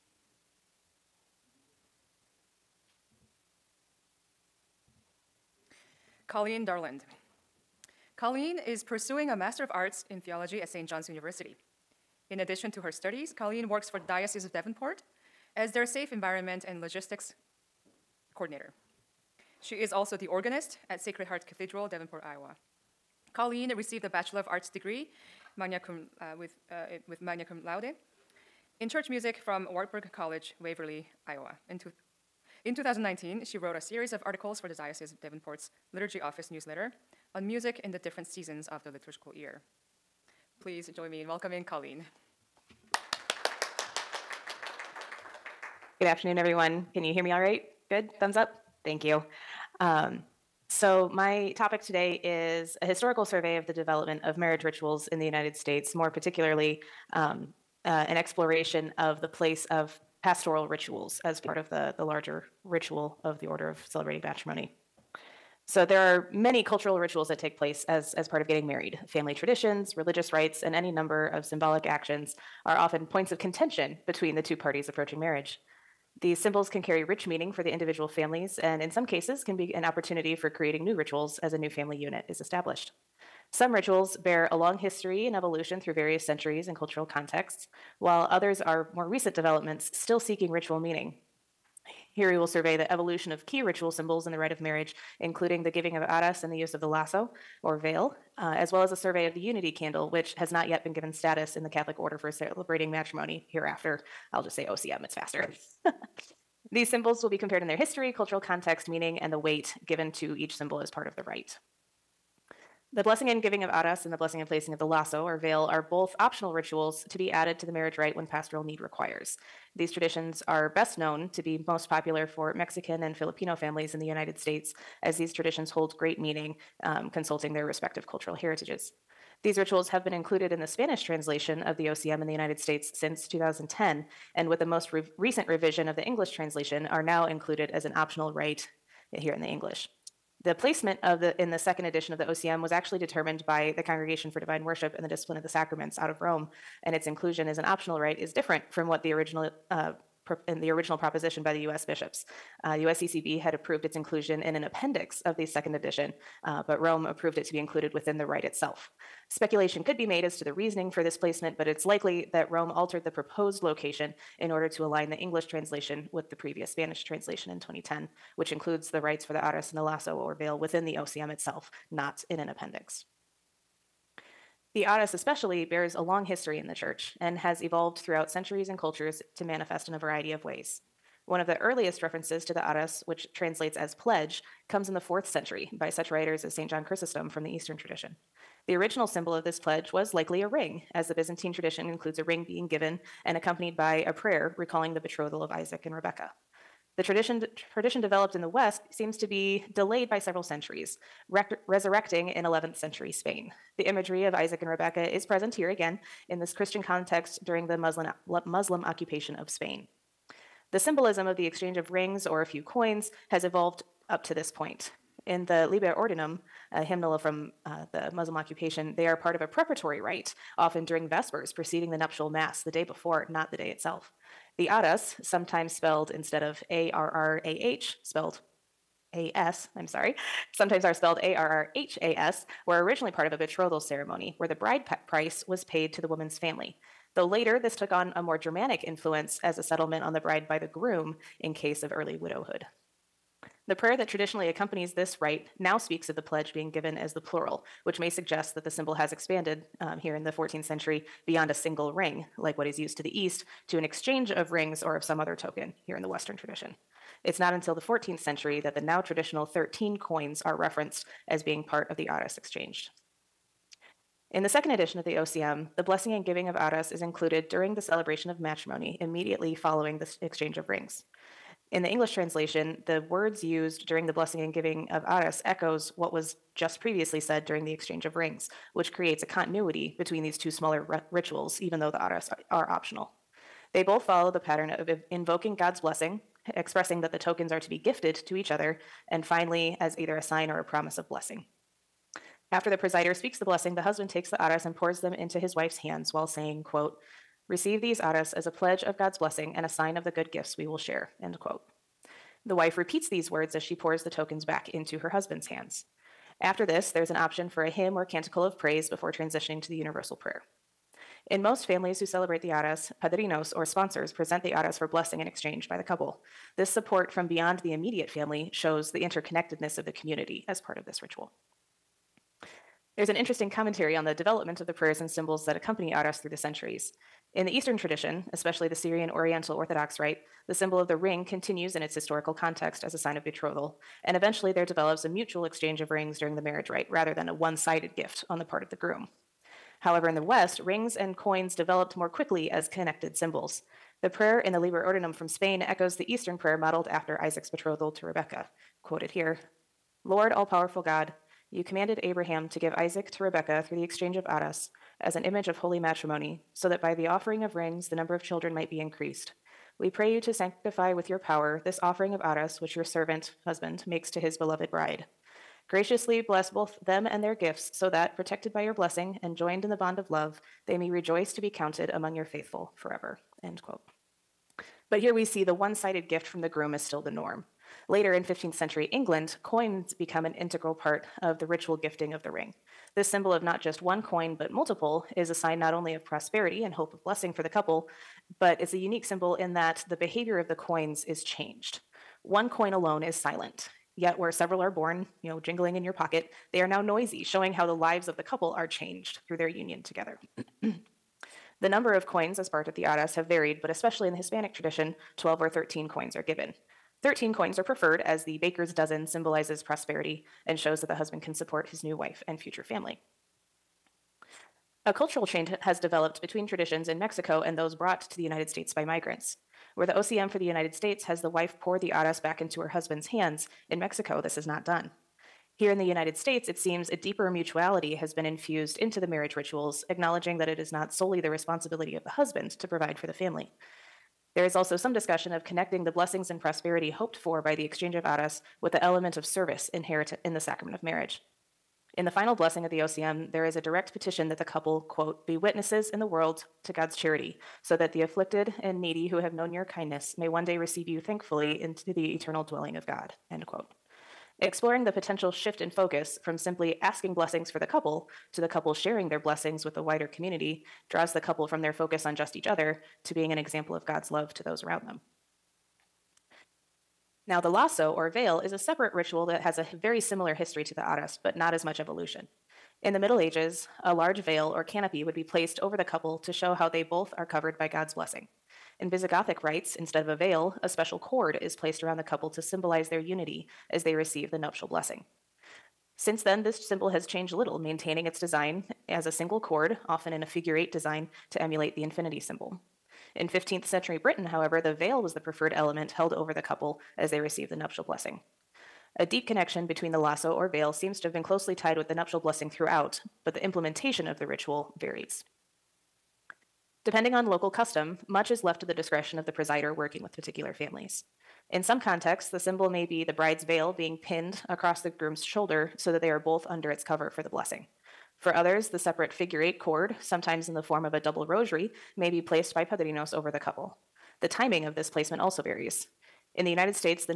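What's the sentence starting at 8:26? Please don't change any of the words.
Depending on local custom, much is left to the discretion of the presider working with particular families.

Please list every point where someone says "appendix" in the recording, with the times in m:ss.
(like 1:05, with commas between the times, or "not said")
2:34, 2:52.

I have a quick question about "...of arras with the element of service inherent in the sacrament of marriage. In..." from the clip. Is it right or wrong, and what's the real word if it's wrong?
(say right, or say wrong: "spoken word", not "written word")
right.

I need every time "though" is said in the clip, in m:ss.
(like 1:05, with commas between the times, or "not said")
3:57, 4:41.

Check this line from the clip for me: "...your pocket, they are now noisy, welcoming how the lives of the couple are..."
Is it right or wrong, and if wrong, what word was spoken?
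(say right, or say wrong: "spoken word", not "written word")
wrong: "showing", not "welcoming".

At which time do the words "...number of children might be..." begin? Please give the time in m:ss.
5:57.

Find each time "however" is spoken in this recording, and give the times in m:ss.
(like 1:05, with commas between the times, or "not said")
5:39, 8:14.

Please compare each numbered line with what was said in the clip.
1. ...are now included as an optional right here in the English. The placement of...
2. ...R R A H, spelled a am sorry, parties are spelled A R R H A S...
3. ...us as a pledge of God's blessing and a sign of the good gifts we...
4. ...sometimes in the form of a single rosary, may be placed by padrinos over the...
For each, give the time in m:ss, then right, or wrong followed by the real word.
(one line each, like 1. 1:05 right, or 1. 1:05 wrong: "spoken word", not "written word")
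1. 2:16 right
2. 3:46 wrong: "sometimes", not "parties"
3. 4:58 right
4. 8:40 wrong: "double", not "single".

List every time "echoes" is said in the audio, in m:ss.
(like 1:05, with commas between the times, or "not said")
4:35, 5:45.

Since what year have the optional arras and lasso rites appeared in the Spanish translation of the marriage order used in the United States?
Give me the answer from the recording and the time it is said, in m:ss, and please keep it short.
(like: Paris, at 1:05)
2010, at 2:12.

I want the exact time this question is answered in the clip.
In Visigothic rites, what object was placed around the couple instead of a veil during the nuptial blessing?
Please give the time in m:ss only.
8:00.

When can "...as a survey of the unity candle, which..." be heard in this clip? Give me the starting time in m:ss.
1:38.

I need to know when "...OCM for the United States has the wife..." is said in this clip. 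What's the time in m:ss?
6:59.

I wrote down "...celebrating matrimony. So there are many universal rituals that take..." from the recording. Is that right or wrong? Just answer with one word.
wrong.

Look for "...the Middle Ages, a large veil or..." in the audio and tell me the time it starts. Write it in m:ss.
7:52.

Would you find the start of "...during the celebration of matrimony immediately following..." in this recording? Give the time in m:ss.
4:27.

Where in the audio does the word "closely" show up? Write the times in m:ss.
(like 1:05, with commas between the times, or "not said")
8:21.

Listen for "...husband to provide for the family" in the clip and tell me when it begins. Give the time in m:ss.
7:12.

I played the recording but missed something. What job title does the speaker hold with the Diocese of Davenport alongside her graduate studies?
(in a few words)
Safe Environment and Logistics Coordinator.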